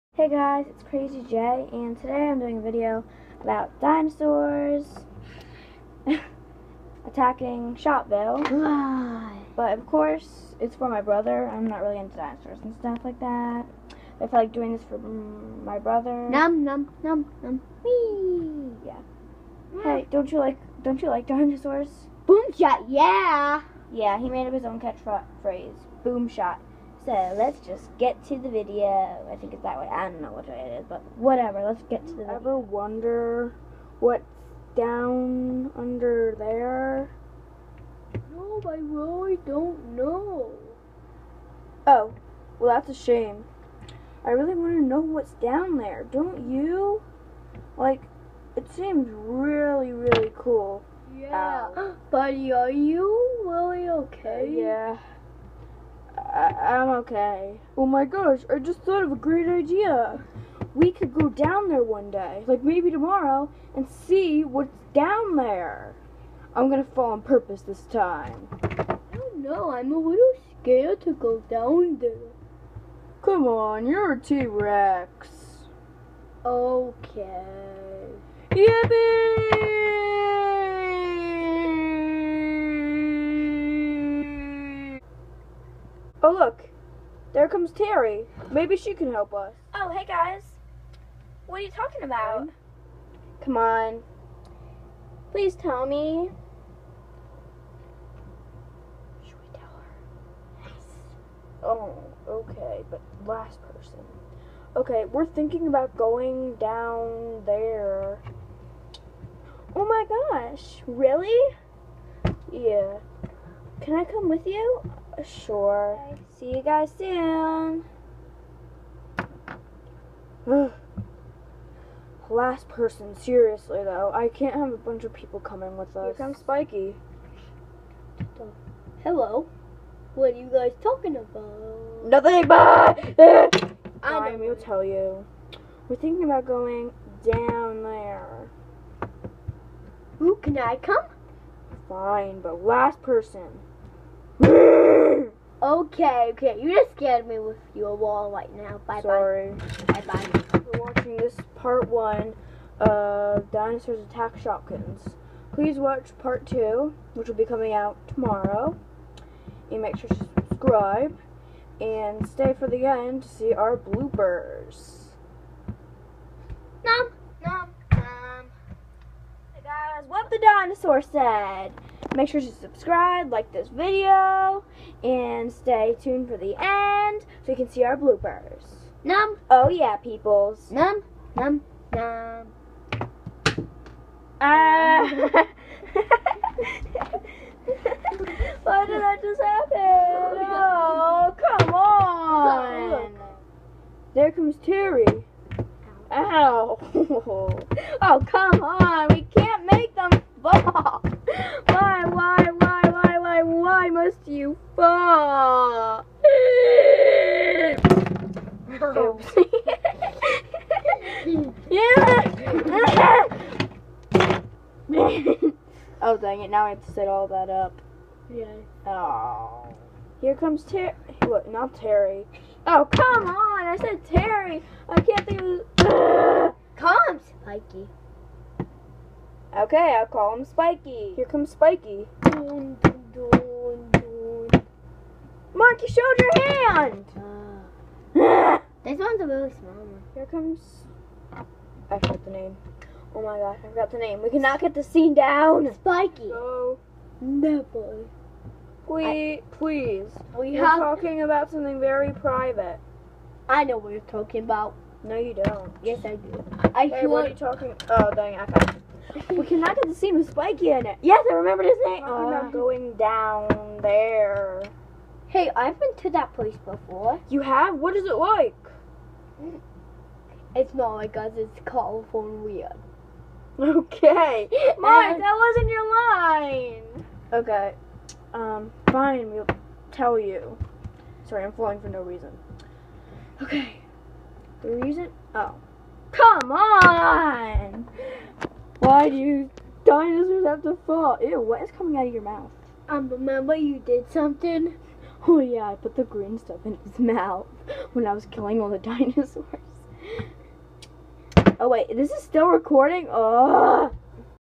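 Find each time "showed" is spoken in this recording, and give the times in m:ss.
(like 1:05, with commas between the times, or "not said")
3:55.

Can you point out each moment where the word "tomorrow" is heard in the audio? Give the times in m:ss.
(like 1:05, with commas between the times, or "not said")
1:02, 2:38.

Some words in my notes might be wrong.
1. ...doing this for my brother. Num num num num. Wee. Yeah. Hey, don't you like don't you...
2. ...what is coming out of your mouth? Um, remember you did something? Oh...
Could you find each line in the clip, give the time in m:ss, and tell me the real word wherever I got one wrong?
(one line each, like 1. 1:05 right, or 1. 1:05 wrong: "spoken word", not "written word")
1. 0:14 right
2. 4:51 right.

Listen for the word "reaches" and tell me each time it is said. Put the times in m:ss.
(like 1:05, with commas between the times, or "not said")
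not said.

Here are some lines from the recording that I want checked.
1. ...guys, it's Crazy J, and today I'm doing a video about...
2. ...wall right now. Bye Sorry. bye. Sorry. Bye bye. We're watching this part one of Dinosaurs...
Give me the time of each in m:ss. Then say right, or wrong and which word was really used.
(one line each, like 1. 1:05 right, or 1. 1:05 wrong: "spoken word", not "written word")
1. 0:00 right
2. 2:27 right.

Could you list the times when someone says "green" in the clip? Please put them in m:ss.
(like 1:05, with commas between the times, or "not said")
4:56.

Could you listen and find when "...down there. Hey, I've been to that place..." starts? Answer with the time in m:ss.
4:22.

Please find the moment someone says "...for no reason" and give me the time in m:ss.
4:41.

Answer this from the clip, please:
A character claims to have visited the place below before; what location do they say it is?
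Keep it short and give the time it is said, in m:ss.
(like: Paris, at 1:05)
California, at 4:31.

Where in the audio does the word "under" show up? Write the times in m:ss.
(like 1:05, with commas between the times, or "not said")
0:35.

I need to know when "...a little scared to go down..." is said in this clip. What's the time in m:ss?
1:09.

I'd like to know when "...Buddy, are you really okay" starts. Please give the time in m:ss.
0:52.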